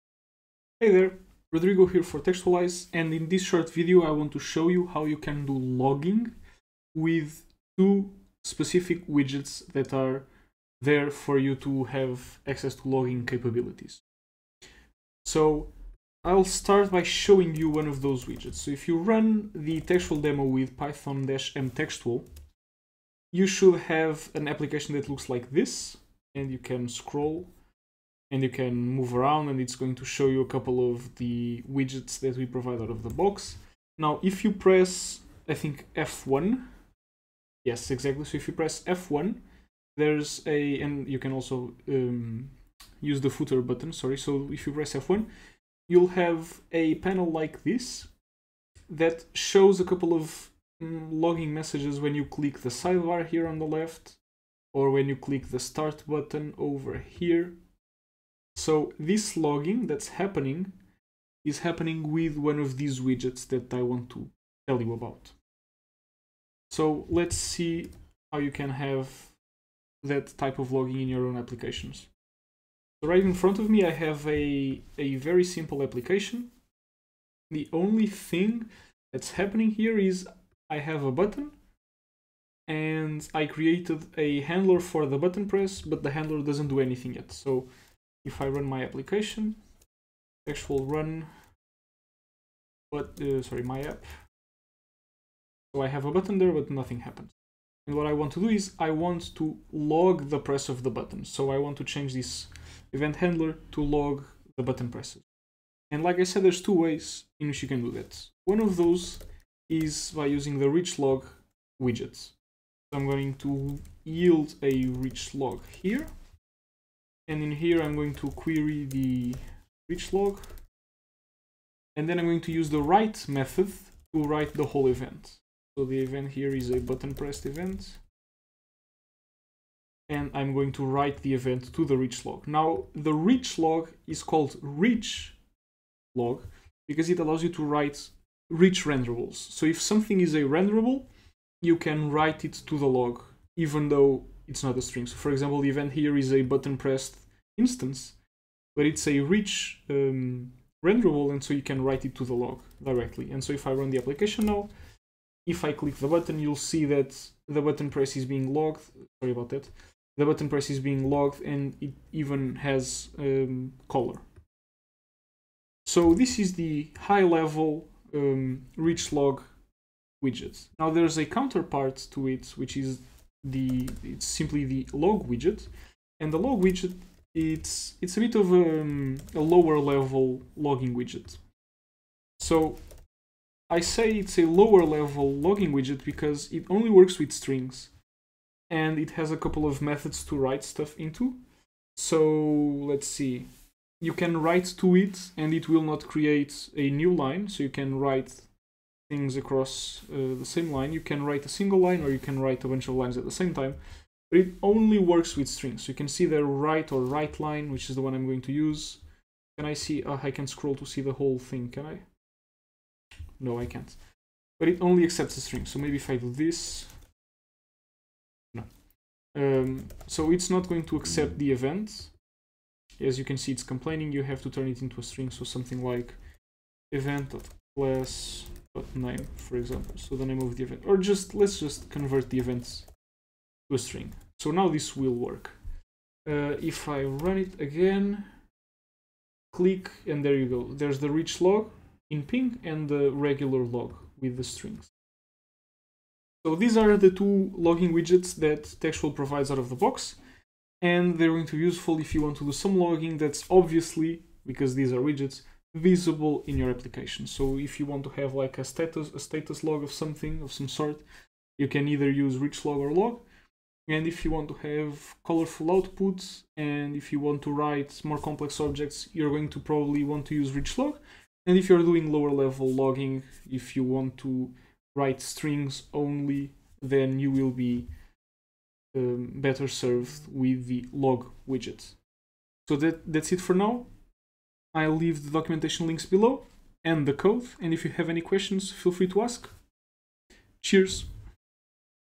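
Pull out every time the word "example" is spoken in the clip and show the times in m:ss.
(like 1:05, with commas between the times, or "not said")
2:25, 3:49.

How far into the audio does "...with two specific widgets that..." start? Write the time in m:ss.
0:06.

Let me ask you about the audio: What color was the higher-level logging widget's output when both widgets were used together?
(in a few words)
pink.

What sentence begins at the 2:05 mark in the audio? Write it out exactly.
So the event here is a button pressed event and I'm going to write the event to the rich log.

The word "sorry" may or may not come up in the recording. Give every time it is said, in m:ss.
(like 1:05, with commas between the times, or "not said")
0:43, 1:33, 2:39.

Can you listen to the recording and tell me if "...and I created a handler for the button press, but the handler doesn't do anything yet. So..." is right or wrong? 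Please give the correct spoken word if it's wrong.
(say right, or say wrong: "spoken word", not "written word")
right.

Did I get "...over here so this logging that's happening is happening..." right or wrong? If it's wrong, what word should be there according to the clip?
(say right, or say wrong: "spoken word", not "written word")
right.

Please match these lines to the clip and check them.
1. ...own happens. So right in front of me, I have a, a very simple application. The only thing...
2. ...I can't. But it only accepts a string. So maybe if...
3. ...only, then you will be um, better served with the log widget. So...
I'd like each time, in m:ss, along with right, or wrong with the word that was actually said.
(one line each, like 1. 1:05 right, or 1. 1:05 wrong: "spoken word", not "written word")
1. 1:11 wrong: "applications", not "happens"
2. 3:33 right
3. 4:35 right.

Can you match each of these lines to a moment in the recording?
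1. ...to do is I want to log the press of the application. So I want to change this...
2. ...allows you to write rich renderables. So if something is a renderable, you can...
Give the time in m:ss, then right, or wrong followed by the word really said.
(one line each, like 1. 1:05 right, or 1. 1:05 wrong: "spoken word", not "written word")
1. 1:38 wrong: "button", not "application"
2. 2:17 right.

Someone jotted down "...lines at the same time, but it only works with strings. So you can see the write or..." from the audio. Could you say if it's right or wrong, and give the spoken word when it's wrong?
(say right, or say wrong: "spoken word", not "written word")
right.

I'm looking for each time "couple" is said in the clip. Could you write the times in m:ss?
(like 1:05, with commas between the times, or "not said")
0:30, 0:49, 3:09.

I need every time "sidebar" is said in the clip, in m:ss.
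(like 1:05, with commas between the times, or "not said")
0:52.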